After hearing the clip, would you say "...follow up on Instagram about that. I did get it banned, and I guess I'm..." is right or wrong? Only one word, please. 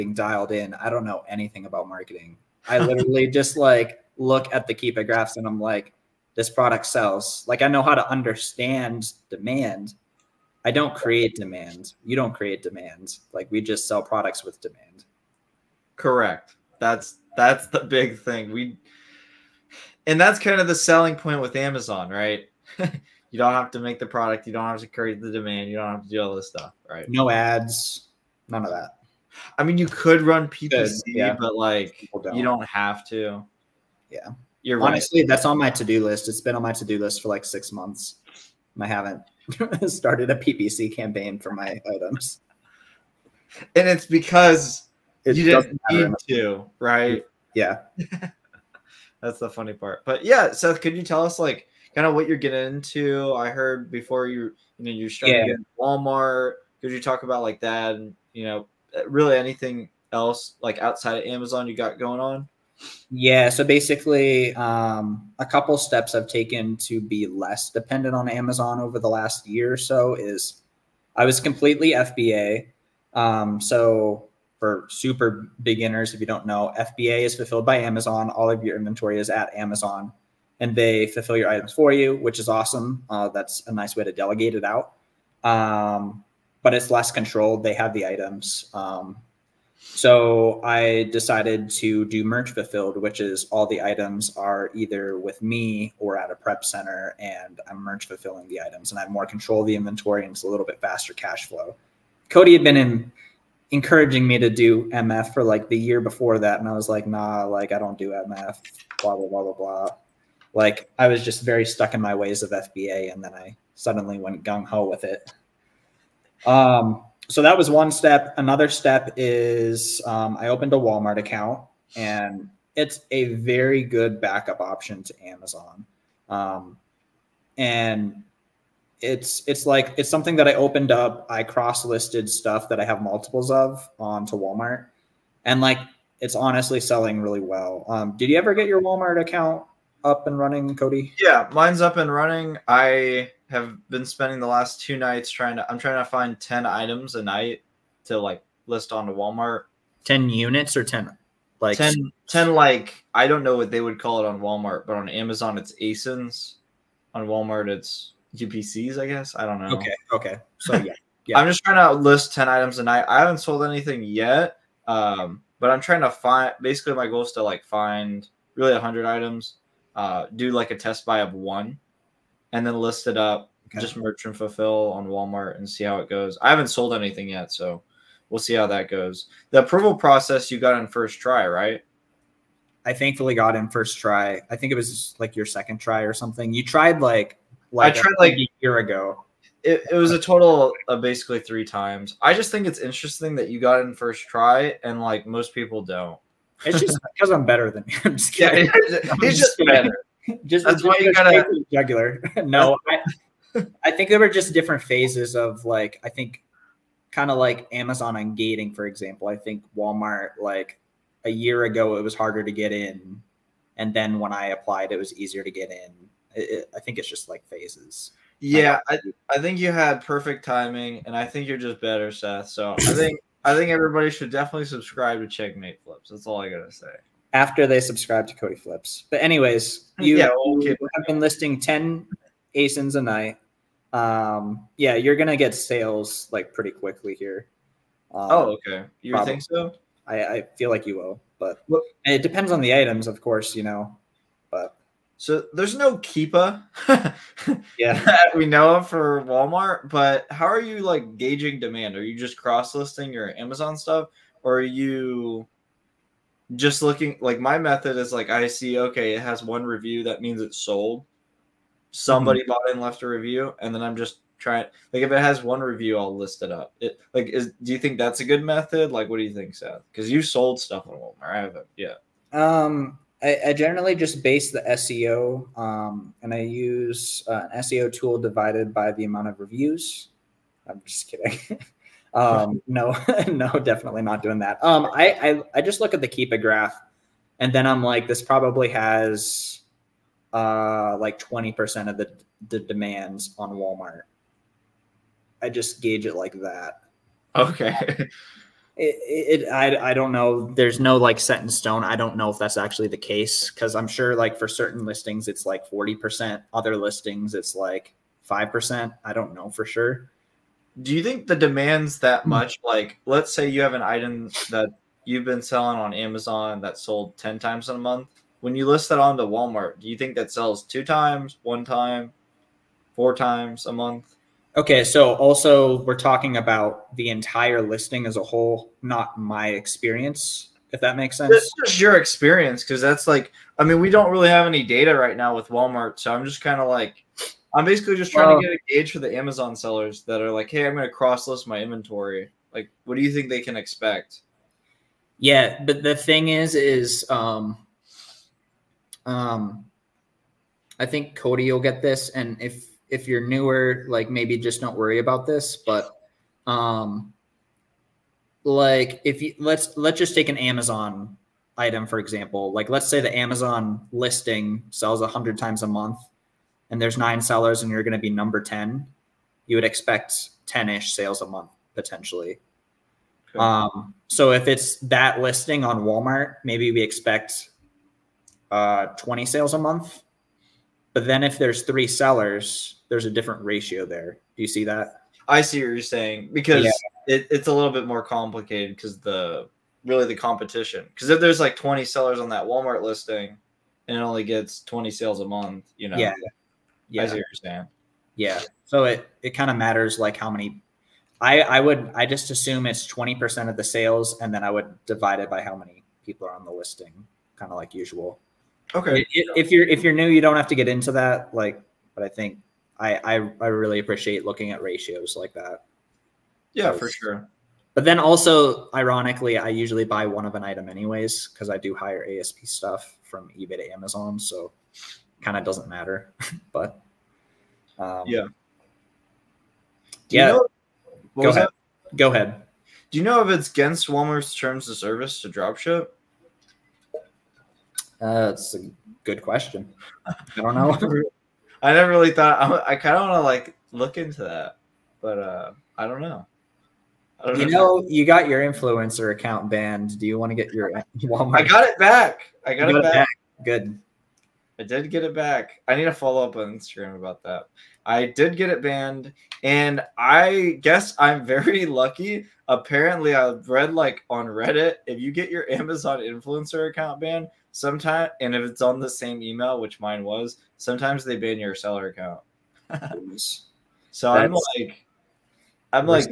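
right.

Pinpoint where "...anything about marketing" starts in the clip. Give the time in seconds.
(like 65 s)
1 s.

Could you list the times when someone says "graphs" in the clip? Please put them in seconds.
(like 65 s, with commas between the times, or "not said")
5 s, 286 s.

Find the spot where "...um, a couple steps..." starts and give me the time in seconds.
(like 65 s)
64 s.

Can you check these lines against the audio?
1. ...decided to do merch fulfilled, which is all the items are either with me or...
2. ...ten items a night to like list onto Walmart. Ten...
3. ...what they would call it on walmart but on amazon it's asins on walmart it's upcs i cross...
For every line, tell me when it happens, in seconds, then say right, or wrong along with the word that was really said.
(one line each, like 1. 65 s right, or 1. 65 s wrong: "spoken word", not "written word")
1. 91 s right
2. 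146 s right
3. 153 s wrong: "guess", not "cross".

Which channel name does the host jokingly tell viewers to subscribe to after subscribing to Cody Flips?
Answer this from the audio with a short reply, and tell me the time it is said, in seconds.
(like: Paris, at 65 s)
Checkmate Flips, at 225 s.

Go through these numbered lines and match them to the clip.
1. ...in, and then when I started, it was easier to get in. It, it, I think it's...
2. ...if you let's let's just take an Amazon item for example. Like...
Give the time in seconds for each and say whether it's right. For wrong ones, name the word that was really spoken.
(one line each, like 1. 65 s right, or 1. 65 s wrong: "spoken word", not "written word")
1. 212 s wrong: "applied", not "started"
2. 359 s right.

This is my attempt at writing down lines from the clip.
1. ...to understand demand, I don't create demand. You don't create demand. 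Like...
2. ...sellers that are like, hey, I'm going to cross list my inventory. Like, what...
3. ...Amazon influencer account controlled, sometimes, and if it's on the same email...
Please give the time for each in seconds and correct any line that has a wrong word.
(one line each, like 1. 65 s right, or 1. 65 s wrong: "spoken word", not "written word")
1. 7 s right
2. 339 s right
3. 465 s wrong: "banned", not "controlled".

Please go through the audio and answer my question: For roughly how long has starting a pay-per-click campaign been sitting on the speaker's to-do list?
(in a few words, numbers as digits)
6 months.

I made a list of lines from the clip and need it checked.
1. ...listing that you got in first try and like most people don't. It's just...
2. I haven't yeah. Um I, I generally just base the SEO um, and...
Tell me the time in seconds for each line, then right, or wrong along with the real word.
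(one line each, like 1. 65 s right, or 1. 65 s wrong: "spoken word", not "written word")
1. 192 s wrong: "interesting", not "listing"
2. 271 s right.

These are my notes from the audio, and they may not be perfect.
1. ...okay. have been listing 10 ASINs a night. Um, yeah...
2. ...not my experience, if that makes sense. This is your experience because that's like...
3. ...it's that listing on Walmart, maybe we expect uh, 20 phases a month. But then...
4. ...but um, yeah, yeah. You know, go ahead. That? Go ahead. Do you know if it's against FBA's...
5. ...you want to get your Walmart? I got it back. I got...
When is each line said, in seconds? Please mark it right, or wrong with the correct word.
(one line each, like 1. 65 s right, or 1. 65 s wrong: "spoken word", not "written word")
1. 230 s right
2. 328 s right
3. 374 s wrong: "sales", not "phases"
4. 426 s wrong: "Walmart", not "FBA"
5. 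450 s right.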